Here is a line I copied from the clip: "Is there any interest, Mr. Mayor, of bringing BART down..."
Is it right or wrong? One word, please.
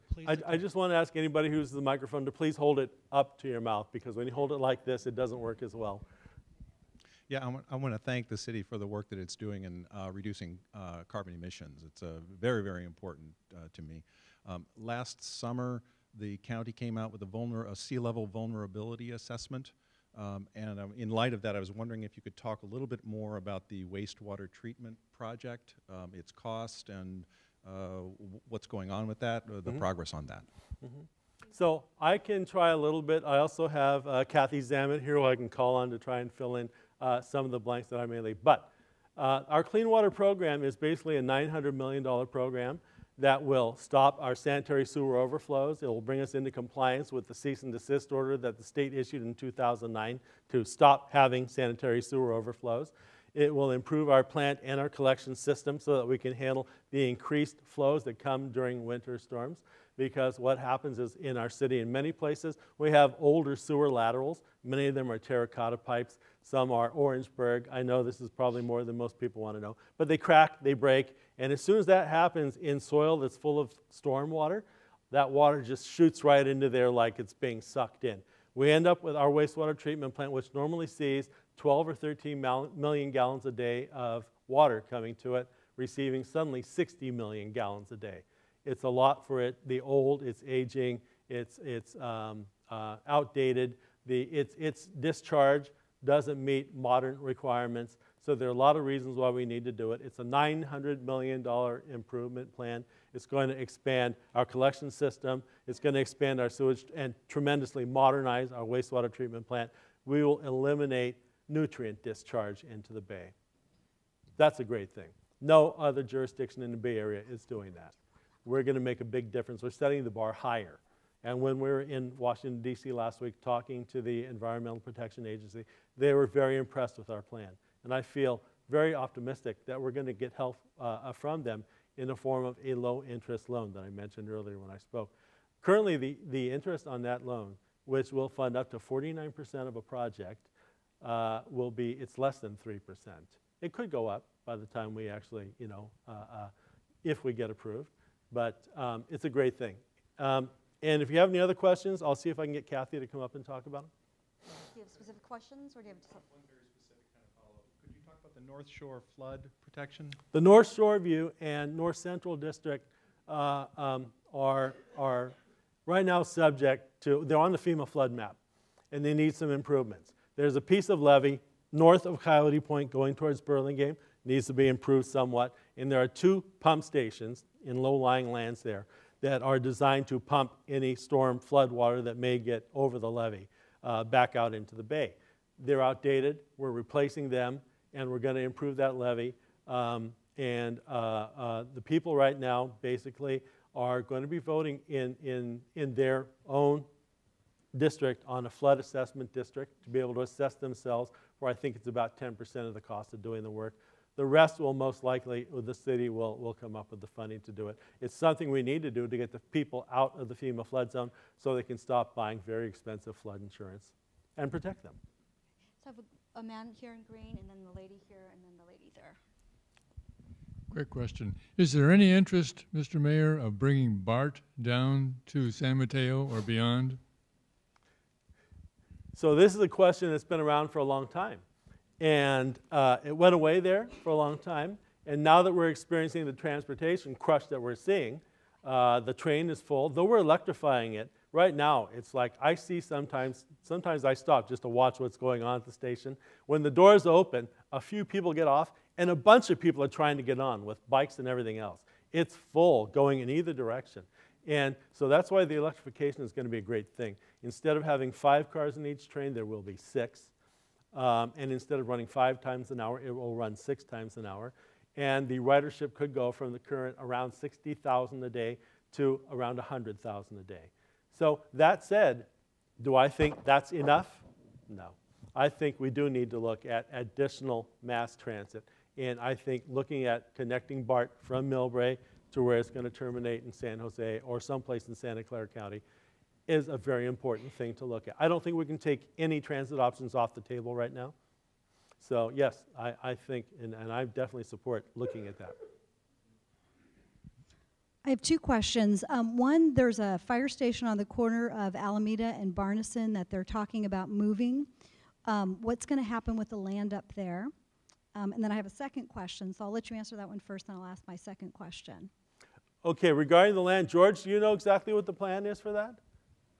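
right.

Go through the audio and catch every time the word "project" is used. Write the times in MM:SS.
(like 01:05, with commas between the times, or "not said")
00:25, 02:19.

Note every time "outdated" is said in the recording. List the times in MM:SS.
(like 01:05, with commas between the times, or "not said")
01:33, 03:05.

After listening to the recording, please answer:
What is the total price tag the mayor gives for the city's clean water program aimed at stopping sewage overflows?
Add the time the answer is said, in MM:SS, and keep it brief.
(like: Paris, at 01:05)
$900 million, at 00:41.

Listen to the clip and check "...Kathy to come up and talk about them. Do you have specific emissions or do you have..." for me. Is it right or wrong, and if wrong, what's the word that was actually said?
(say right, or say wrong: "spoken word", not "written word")
wrong: "questions", not "emissions".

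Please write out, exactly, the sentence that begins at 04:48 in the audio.
I don't think we can take any transit options off the table right now.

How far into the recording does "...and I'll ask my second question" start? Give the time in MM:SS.
05:10.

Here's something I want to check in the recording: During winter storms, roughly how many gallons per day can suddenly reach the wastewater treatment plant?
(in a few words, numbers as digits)
60 million.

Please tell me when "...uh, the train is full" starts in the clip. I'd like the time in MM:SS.
03:58.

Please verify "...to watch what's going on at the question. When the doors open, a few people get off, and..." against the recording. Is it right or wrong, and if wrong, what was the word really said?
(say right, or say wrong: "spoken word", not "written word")
wrong: "station", not "question".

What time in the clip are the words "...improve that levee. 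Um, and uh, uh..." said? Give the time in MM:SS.
03:08.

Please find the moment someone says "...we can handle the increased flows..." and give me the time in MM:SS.
00:56.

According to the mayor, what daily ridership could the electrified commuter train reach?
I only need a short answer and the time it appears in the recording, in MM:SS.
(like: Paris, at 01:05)
100,000, at 04:29.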